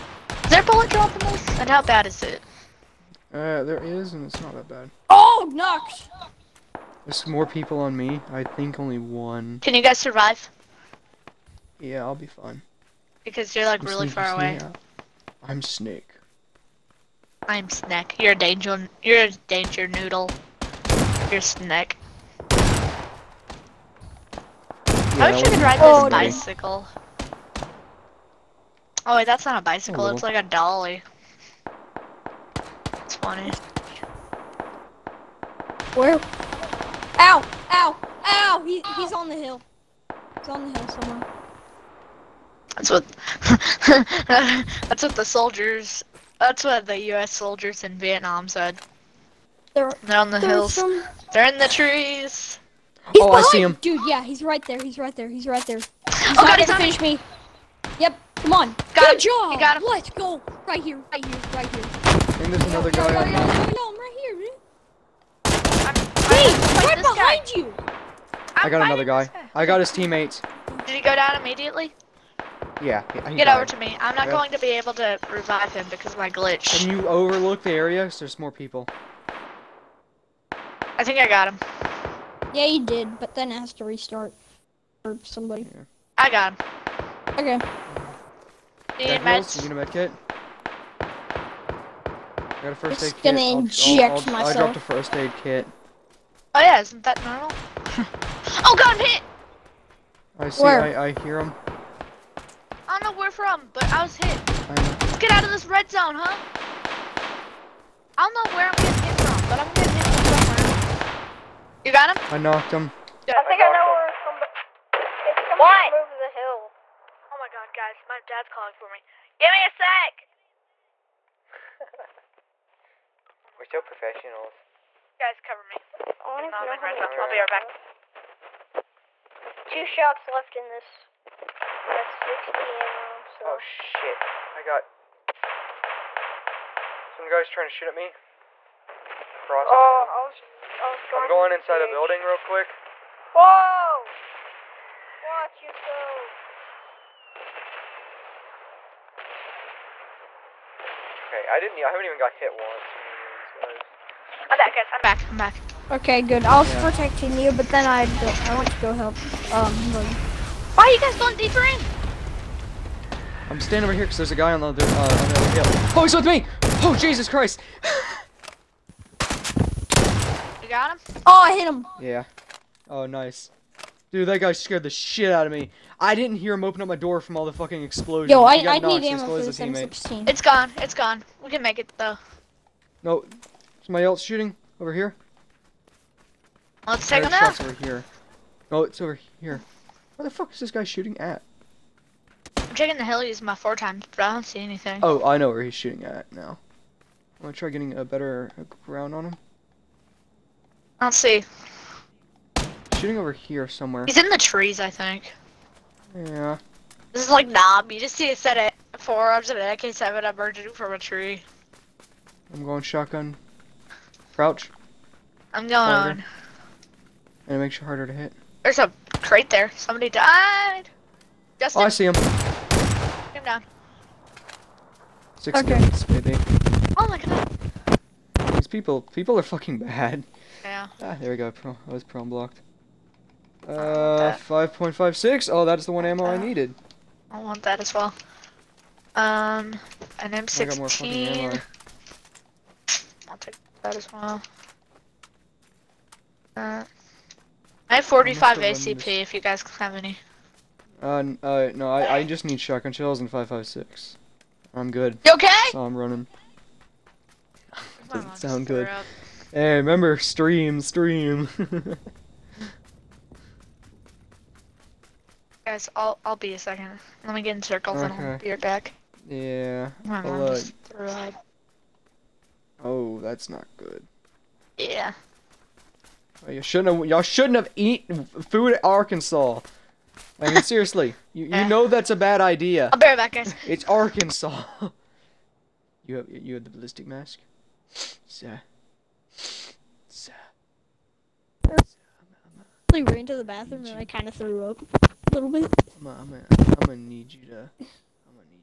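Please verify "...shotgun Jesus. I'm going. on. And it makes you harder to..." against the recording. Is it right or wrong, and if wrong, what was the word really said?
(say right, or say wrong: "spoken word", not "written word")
wrong: "Crouch", not "Jesus".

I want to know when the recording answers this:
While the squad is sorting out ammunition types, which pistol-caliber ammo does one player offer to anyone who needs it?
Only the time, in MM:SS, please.
04:08.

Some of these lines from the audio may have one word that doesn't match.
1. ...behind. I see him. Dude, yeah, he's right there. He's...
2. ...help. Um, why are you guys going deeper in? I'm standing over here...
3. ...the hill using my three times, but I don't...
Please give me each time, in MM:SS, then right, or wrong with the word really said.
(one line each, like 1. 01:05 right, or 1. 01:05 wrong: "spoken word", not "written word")
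1. 00:53 right
2. 02:38 right
3. 03:12 wrong: "four", not "three".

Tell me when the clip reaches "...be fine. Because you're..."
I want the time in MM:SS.
00:12.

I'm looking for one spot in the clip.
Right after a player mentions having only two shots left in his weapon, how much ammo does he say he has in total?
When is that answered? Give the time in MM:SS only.
02:12.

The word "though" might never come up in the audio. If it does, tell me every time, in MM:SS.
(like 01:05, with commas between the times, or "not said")
03:01.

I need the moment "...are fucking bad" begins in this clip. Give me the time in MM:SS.
03:49.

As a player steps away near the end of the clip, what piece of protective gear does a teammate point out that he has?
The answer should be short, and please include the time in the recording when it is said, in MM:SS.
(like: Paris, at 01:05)
ballistic mask, at 04:46.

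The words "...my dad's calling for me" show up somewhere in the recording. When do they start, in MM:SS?
01:58.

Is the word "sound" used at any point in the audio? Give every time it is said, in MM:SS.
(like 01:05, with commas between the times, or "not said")
04:18.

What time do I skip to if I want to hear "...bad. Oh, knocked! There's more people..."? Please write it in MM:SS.
00:04.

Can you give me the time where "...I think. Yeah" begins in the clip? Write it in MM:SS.
03:24.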